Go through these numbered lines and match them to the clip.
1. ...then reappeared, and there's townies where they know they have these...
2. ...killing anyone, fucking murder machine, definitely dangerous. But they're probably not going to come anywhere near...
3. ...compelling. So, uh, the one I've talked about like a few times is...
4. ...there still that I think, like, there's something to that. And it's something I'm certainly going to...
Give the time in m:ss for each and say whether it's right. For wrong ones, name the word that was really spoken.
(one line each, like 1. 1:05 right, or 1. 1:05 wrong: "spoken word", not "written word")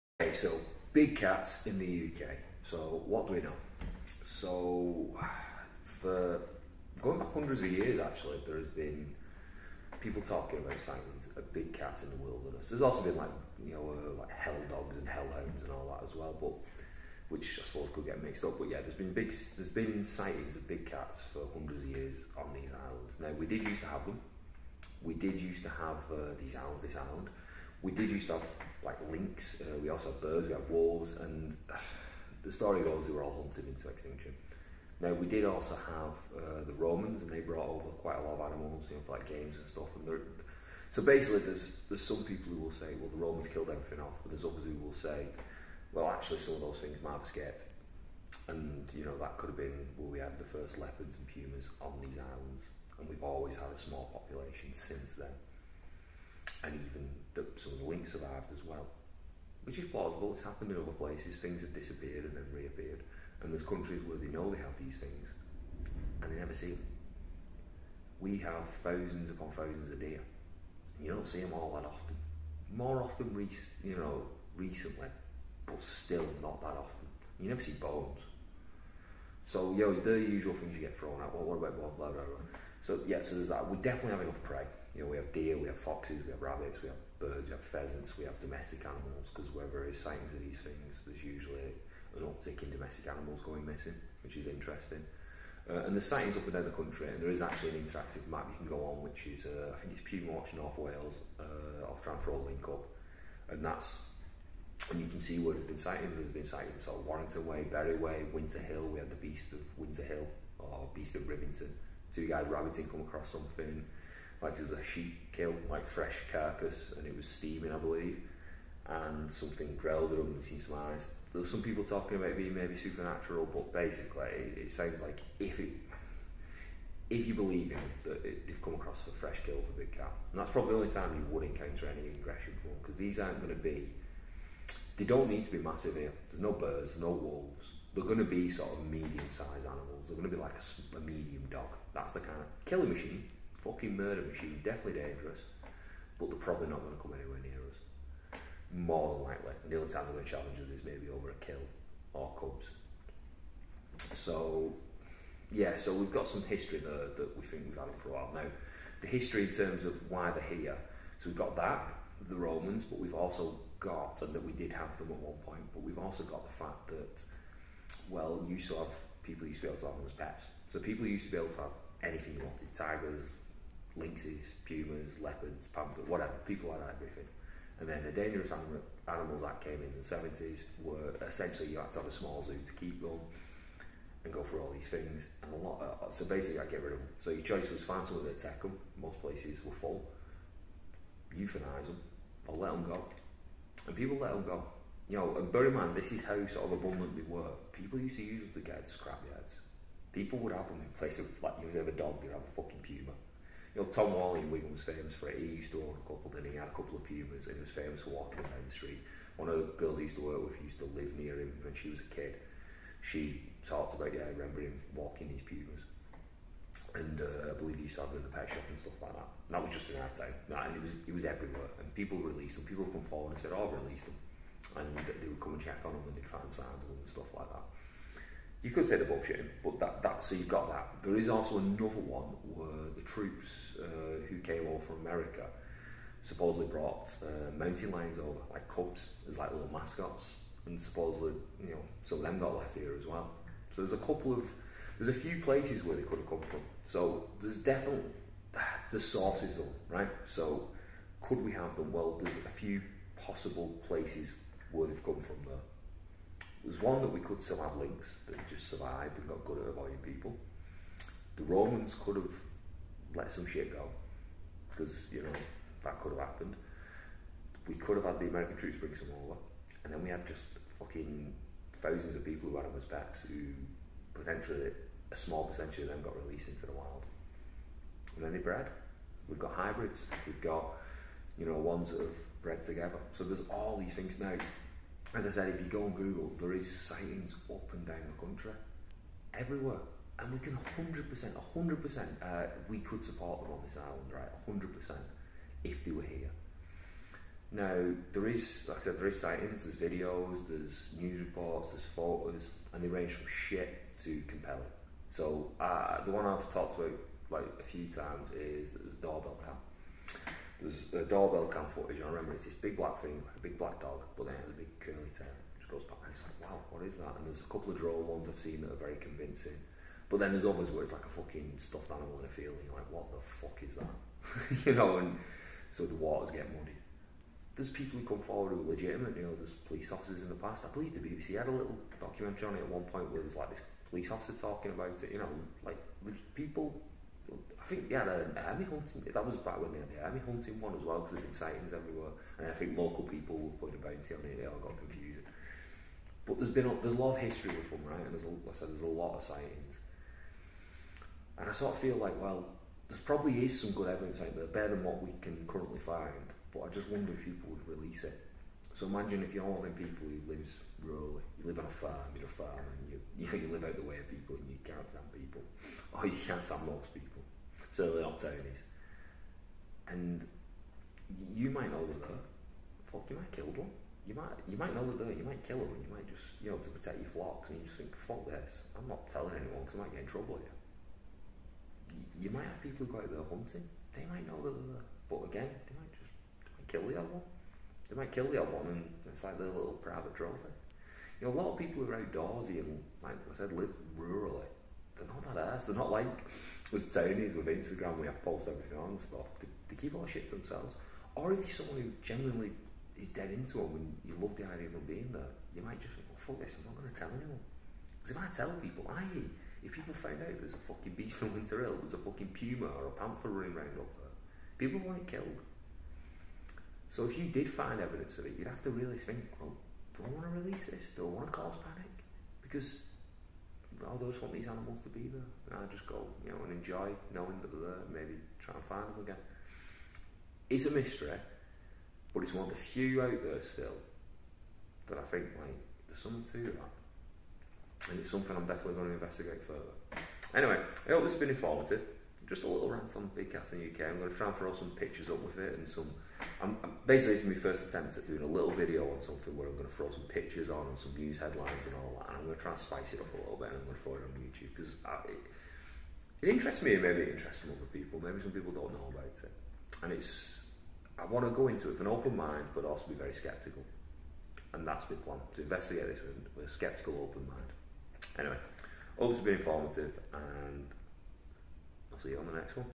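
1. 1:02 wrong: "countries", not "townies"
2. 2:22 wrong: "machine", not "anyone"
3. 5:04 right
4. 7:13 wrong: "definitely", not "certainly".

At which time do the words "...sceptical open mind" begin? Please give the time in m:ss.
7:46.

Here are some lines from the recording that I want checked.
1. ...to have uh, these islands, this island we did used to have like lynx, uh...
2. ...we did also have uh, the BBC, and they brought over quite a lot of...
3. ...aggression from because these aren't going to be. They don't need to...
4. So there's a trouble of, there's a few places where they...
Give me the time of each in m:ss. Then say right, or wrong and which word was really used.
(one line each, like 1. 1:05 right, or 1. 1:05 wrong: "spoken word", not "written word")
1. 0:25 right
2. 0:35 wrong: "Romans", not "BBC"
3. 2:12 right
4. 4:03 wrong: "couple", not "trouble".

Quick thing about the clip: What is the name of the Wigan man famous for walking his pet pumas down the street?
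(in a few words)
Tom Wally.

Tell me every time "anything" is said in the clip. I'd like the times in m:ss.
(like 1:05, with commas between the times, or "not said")
2:52.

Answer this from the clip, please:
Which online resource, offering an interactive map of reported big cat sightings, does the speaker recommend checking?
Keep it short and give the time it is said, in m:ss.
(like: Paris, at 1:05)
Puma Watch North Wales, at 1:40.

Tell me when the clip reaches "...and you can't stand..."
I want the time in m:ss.
6:04.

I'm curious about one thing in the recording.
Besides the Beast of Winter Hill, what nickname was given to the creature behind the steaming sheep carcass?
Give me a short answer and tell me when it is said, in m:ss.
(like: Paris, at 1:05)
Beast of Rivington, at 1:50.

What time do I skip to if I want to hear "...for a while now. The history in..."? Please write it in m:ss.
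2:38.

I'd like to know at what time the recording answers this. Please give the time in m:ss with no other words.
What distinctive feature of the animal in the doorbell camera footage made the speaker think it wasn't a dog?
5:14.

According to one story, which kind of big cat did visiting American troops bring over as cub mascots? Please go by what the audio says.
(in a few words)
Mountain lions.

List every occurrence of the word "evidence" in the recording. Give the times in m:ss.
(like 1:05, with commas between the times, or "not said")
5:53, 6:57.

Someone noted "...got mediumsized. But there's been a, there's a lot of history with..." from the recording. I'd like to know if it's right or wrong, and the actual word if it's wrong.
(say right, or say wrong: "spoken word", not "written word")
wrong: "confused", not "mediumsized".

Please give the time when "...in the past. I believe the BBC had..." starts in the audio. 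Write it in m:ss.
5:30.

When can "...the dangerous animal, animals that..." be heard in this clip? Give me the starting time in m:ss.
2:58.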